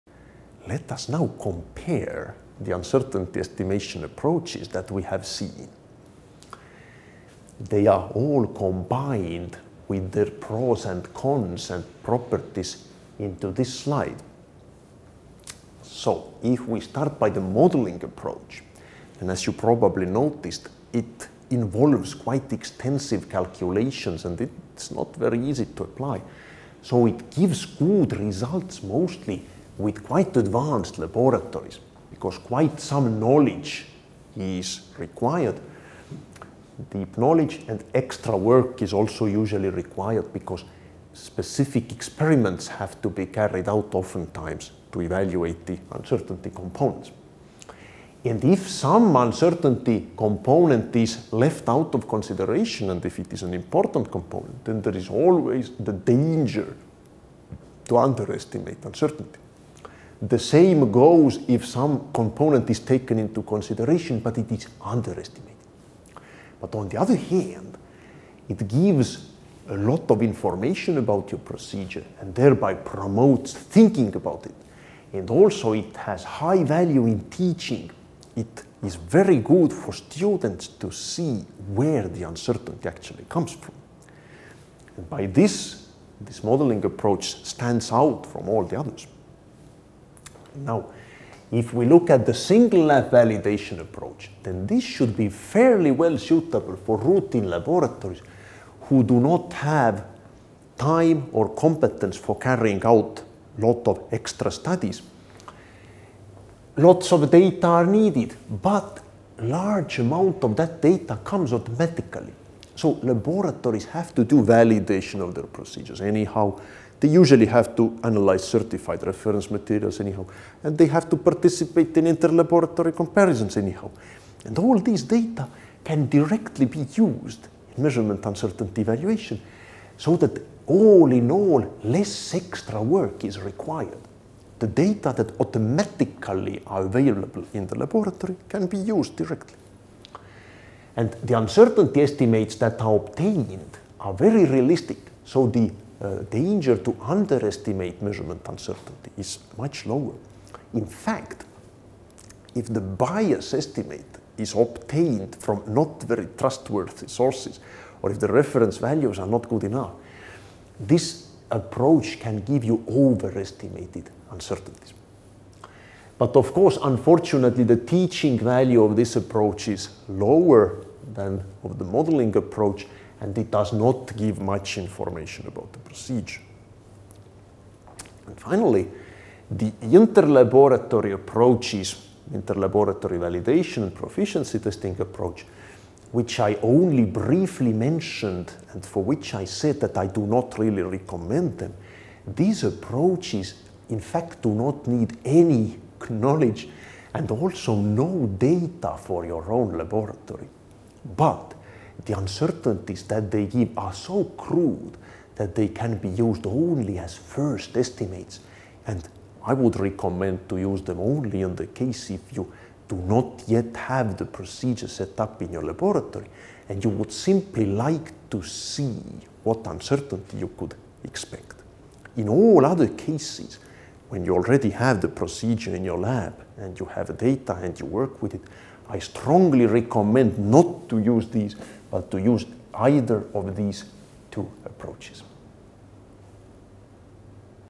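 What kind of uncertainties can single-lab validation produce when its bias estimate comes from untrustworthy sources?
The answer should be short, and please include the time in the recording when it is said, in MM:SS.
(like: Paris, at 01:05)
overestimated uncertainties, at 02:42.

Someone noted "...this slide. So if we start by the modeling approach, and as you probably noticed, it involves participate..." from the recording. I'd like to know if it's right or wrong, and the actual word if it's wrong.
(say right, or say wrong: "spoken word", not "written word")
wrong: "quite", not "participate".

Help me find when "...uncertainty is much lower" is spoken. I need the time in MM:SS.
02:28.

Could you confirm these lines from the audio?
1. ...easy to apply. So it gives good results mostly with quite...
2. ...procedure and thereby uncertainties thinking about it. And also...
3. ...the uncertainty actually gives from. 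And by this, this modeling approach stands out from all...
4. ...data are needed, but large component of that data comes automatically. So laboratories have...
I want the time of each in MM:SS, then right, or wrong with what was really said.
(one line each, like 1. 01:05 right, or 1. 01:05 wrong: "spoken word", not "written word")
1. 00:25 right
2. 01:11 wrong: "promotes", not "uncertainties"
3. 01:22 wrong: "comes", not "gives"
4. 01:47 wrong: "amount", not "component".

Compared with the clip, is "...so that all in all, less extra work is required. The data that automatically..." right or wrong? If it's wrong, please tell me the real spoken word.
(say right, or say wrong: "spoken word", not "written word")
right.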